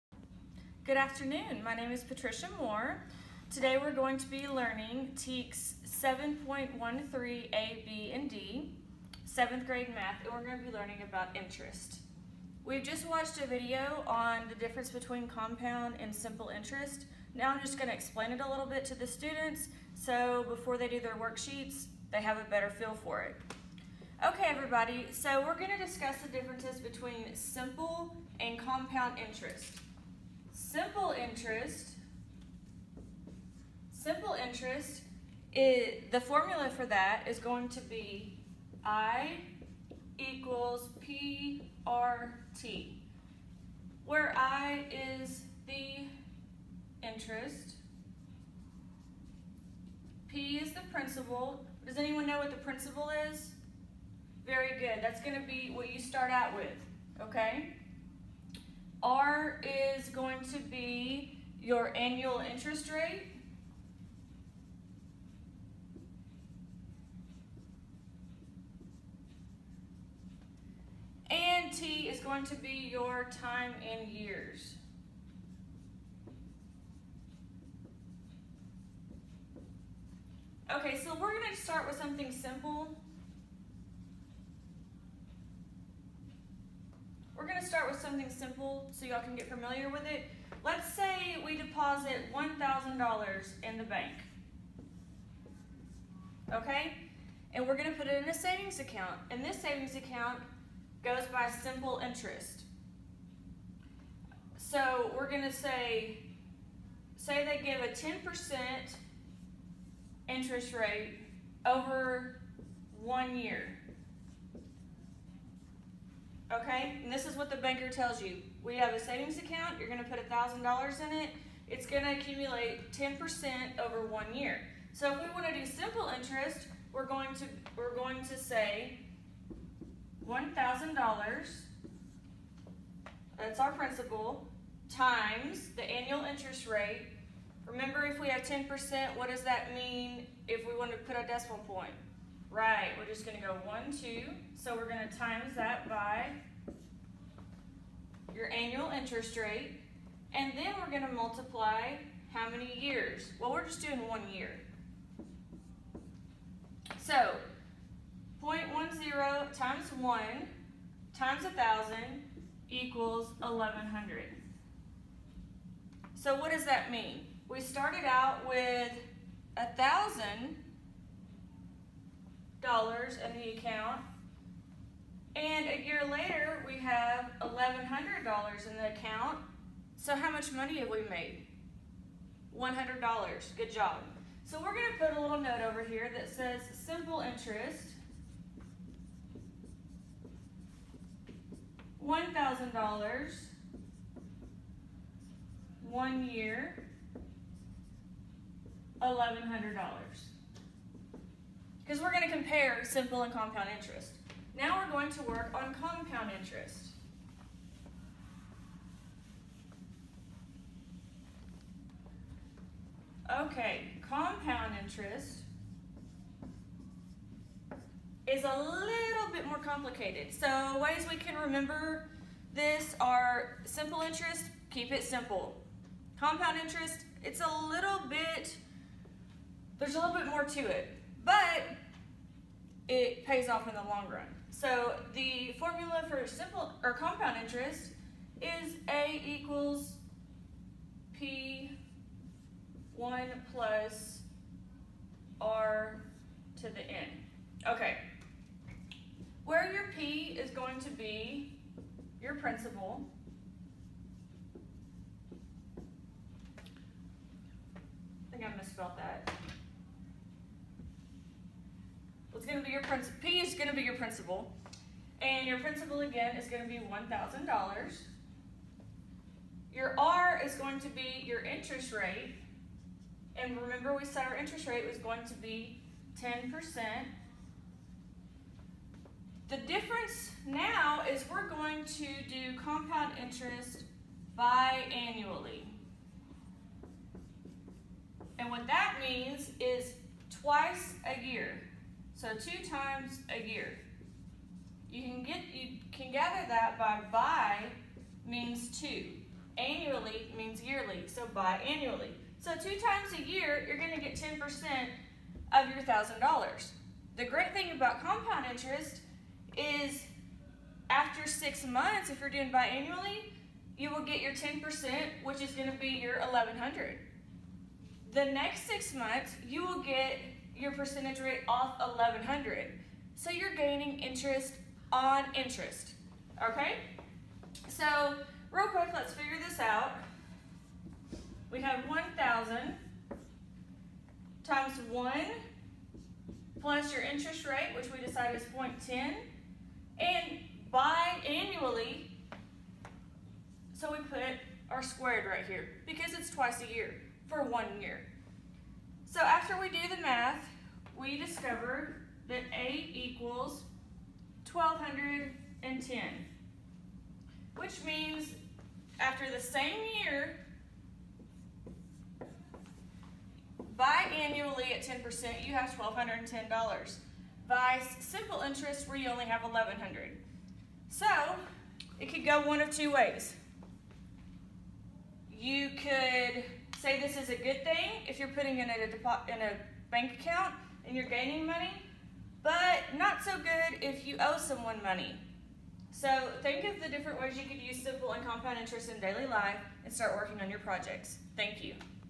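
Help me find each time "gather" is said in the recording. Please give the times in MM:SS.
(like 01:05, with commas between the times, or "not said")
04:56.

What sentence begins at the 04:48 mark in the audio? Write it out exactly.
And what that means is twice a year.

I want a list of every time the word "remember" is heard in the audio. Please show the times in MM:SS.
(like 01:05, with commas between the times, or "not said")
02:17, 03:41, 04:33.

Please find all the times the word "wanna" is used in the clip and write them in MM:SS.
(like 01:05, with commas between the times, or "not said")
02:05, 02:20.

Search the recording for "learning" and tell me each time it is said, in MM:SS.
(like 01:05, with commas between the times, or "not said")
00:04, 00:10.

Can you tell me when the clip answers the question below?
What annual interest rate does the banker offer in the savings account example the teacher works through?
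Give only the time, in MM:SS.
01:47.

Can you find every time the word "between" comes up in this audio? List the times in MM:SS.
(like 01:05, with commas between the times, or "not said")
00:14, 00:26.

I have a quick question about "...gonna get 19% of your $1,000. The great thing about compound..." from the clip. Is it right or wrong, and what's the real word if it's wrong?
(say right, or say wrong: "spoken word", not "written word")
wrong: "10", not "19".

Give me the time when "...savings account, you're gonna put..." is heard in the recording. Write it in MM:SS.
01:58.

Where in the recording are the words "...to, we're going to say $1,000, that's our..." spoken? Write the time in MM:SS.
02:07.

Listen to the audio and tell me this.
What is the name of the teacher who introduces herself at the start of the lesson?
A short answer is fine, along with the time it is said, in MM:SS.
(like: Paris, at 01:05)
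Patricia Moore, at 00:02.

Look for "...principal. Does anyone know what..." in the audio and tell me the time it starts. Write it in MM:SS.
00:50.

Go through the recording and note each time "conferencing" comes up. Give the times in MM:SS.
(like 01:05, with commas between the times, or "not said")
not said.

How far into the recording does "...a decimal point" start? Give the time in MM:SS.
02:21.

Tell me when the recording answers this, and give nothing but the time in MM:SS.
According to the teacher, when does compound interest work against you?
06:23.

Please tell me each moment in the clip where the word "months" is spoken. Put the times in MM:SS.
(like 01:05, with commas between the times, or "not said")
05:11, 05:18.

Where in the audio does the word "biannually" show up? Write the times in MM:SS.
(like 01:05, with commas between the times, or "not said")
04:44, 05:12, 05:40, 06:03.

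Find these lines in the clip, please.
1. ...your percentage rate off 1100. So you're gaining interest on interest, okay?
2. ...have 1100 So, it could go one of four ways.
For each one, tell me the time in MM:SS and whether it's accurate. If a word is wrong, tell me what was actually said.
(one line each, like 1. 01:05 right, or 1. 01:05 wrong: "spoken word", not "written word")
1. 05:20 right
2. 06:09 wrong: "two", not "four".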